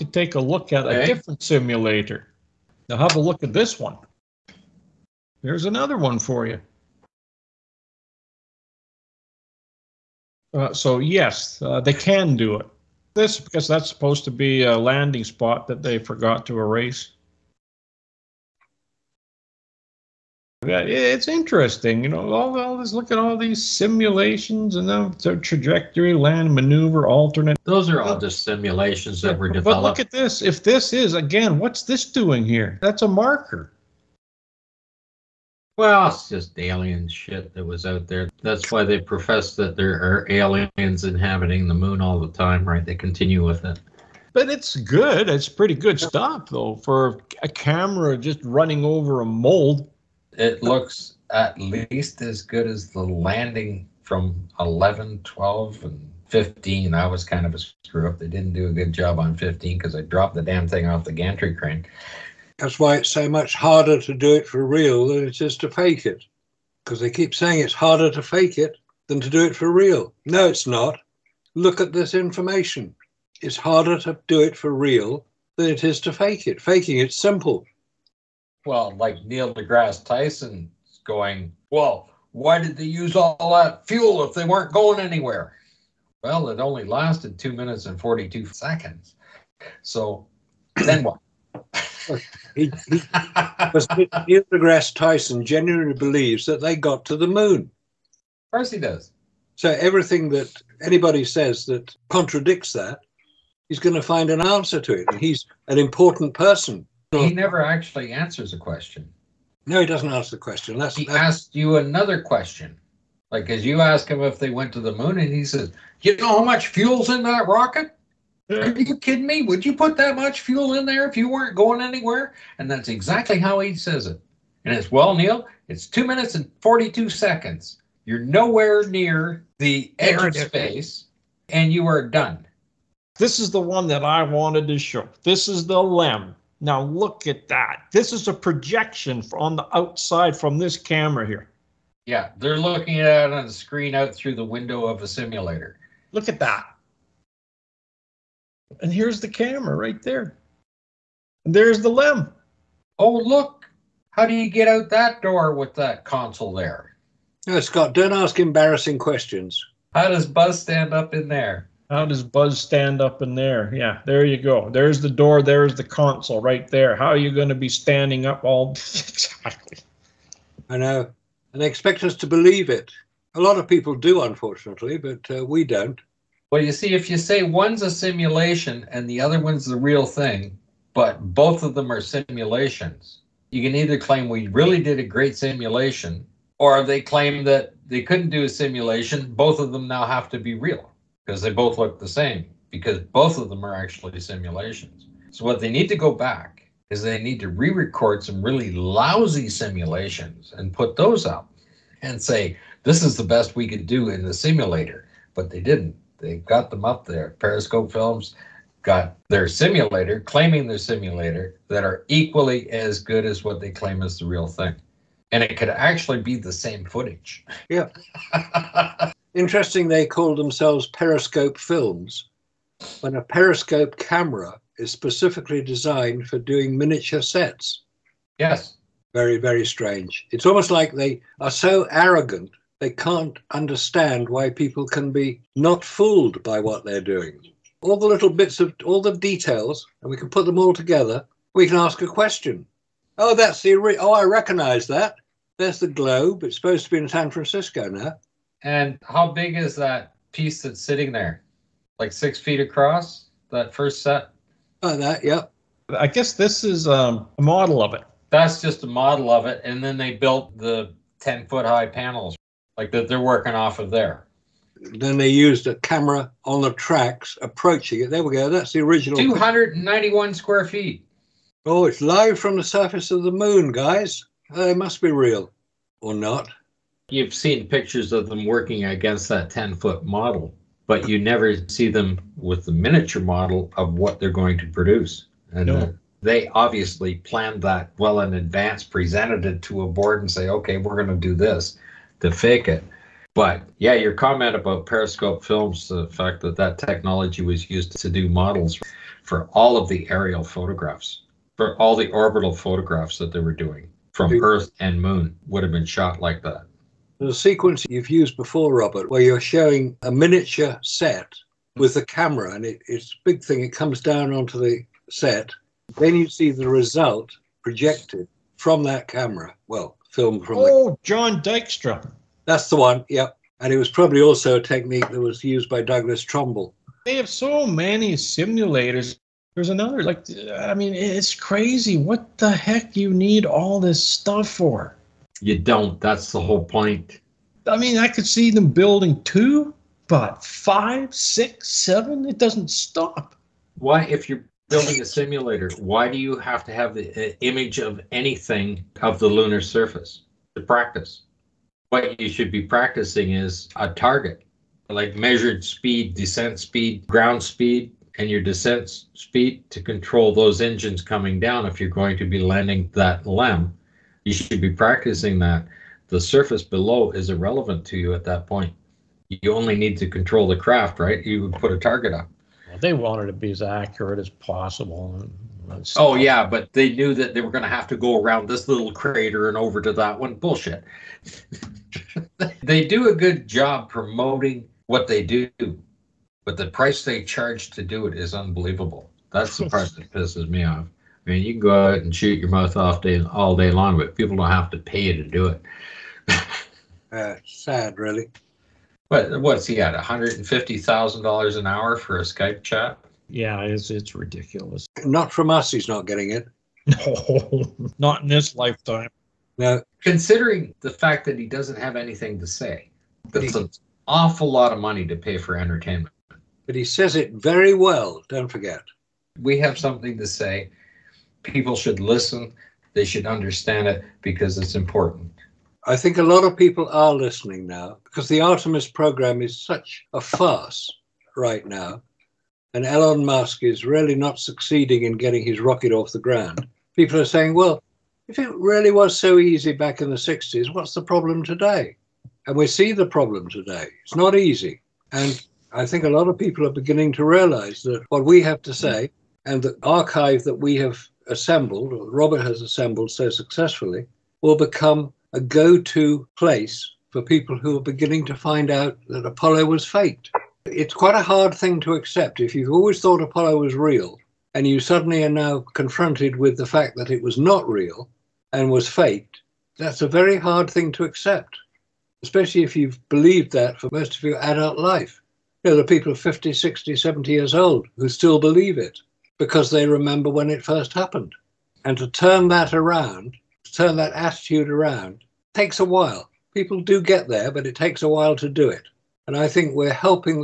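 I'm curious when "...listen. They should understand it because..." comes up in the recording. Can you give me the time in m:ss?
7:01.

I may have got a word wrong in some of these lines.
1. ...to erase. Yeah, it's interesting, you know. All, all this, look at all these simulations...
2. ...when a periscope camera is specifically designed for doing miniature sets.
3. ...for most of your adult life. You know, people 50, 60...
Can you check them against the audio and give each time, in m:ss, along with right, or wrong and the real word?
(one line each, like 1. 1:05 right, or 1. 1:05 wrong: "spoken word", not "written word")
1. 0:16 right
2. 3:43 right
3. 7:53 right.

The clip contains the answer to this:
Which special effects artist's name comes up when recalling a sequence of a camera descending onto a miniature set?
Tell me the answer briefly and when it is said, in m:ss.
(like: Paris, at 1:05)
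John Dykstra, at 5:21.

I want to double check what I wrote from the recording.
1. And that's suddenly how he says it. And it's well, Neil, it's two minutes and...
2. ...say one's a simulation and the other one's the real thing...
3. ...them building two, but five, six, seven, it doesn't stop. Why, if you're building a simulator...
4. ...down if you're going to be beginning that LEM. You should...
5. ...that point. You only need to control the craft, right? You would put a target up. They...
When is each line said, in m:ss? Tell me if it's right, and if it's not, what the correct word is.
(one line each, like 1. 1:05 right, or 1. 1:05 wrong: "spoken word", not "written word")
1. 2:02 wrong: "exactly", not "suddenly"
2. 2:57 right
3. 5:38 right
4. 6:01 wrong: "landing", not "beginning"
5. 6:08 right.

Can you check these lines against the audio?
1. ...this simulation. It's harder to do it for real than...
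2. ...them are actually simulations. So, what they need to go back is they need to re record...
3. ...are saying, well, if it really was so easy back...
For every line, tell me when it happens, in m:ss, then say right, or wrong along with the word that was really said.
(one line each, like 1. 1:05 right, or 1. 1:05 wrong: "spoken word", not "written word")
1. 1:11 wrong: "information", not "simulation"
2. 3:13 right
3. 7:17 right.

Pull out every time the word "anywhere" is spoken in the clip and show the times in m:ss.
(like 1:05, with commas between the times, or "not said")
1:24, 2:01.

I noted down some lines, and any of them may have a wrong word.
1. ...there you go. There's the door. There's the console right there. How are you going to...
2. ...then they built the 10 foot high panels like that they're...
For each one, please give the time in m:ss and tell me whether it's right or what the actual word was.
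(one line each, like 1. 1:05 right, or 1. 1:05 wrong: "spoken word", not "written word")
1. 2:44 right
2. 4:19 right.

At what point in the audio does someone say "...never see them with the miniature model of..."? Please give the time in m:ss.
4:41.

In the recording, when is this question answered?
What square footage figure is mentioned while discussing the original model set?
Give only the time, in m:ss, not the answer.
4:29.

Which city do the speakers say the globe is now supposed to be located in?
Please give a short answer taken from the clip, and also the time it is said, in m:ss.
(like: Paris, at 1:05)
San Francisco, at 4:07.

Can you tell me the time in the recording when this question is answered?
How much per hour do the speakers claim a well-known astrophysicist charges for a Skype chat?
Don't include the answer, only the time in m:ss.
6:39.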